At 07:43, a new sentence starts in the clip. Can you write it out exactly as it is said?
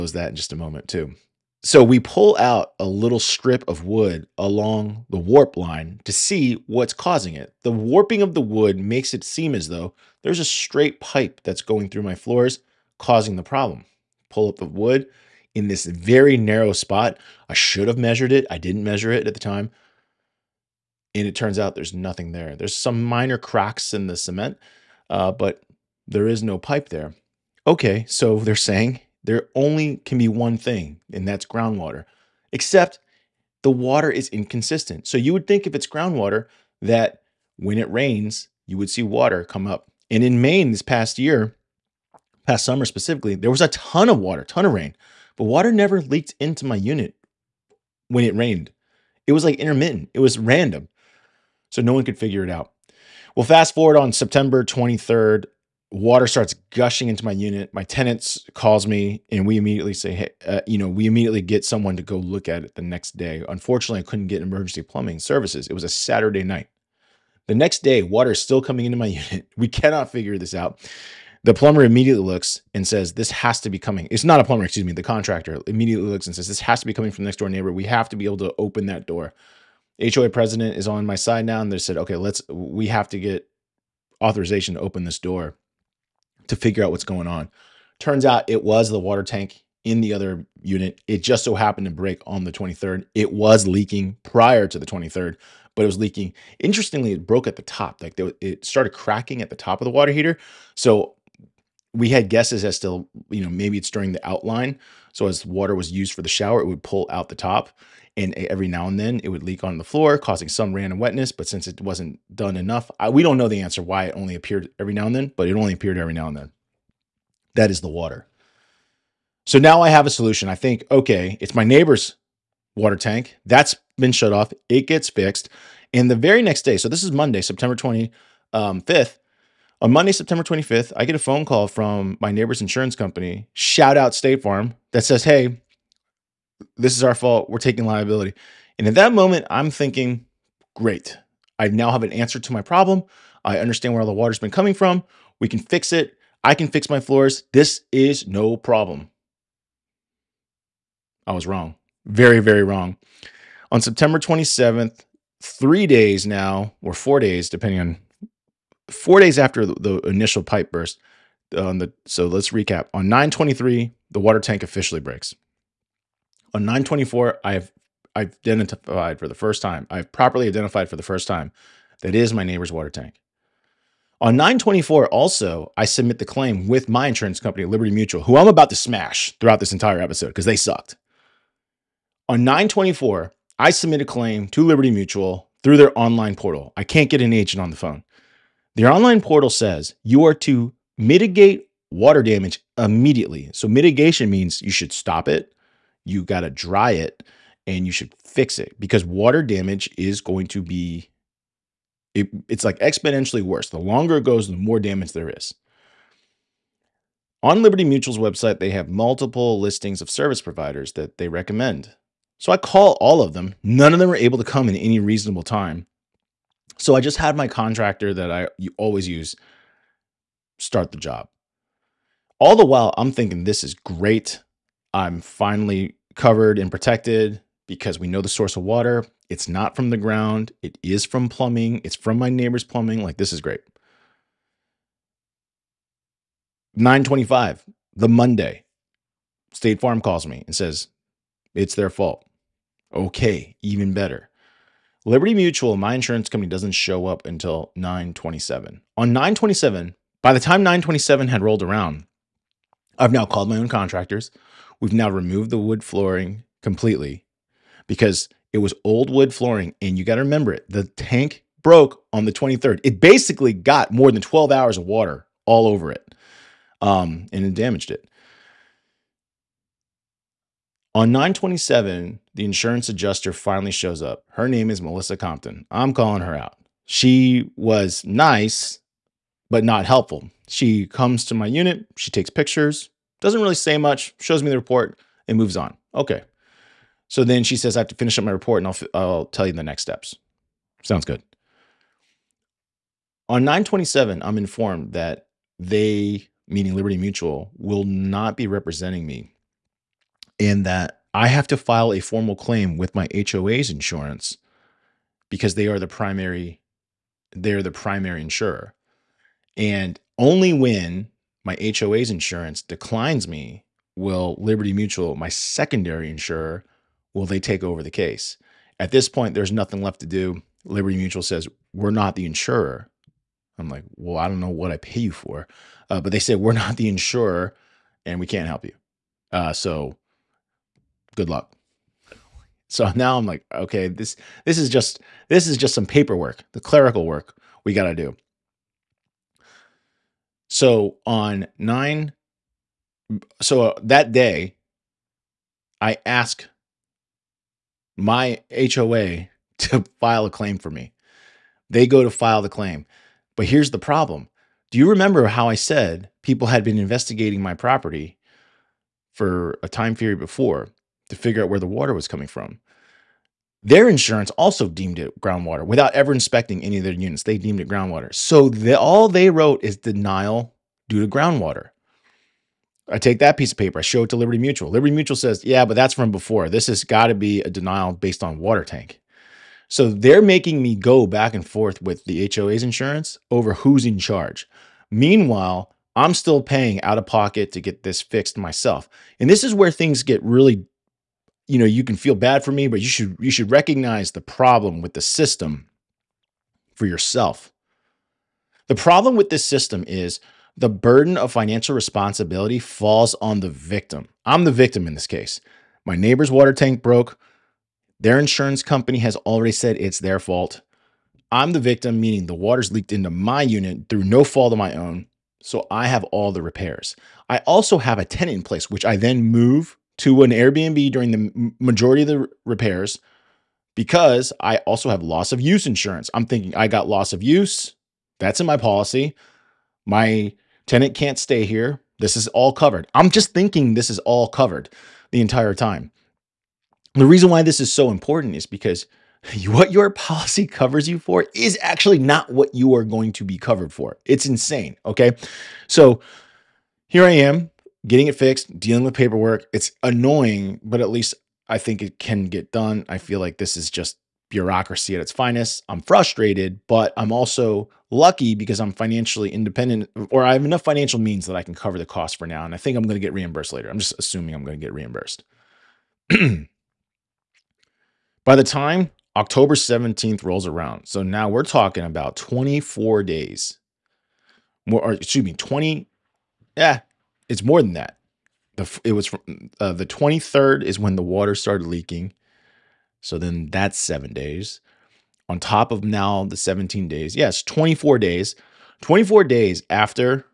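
I'm just assuming I'm going to get reimbursed.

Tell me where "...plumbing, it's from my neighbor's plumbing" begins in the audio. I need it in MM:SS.
03:51.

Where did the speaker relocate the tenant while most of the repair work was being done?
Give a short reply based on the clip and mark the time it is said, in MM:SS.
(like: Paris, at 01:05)
an Airbnb, at 07:00.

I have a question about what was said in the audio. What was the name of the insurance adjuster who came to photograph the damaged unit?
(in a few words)
Melissa Compton.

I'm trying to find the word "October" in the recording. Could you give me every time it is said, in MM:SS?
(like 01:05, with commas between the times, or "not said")
07:49.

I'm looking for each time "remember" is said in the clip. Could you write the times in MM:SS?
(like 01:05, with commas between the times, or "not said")
04:20, 05:54.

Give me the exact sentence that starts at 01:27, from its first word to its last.
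Turns out it was the water tank in the other unit.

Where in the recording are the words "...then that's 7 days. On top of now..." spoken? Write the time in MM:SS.
08:03.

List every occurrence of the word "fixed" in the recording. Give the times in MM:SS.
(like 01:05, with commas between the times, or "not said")
02:05, 06:28, 07:28.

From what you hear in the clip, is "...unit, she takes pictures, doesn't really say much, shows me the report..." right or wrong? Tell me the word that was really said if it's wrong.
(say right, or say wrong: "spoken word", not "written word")
right.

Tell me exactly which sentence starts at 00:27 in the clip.
Okay, so they're saying there only can be one thing, and that's groundwater, except the water is inconsistent.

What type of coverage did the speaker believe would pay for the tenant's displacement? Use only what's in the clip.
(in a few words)
loss of use insurance.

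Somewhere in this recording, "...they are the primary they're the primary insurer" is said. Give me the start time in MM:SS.
05:05.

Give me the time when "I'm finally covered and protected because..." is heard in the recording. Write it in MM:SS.
03:44.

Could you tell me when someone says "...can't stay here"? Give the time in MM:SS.
07:10.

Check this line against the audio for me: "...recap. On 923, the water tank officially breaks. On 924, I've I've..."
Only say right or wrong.
right.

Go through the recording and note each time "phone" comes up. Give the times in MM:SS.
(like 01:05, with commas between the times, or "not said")
02:11, 03:07.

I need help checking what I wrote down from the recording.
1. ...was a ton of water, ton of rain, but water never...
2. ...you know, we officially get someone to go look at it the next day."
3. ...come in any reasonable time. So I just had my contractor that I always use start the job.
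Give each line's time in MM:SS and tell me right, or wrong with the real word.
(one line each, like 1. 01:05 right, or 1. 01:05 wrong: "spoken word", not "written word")
1. 00:43 right
2. 01:00 wrong: "immediately", not "officially"
3. 03:34 right.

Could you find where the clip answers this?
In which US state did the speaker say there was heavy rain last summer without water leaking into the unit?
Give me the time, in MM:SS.
00:40.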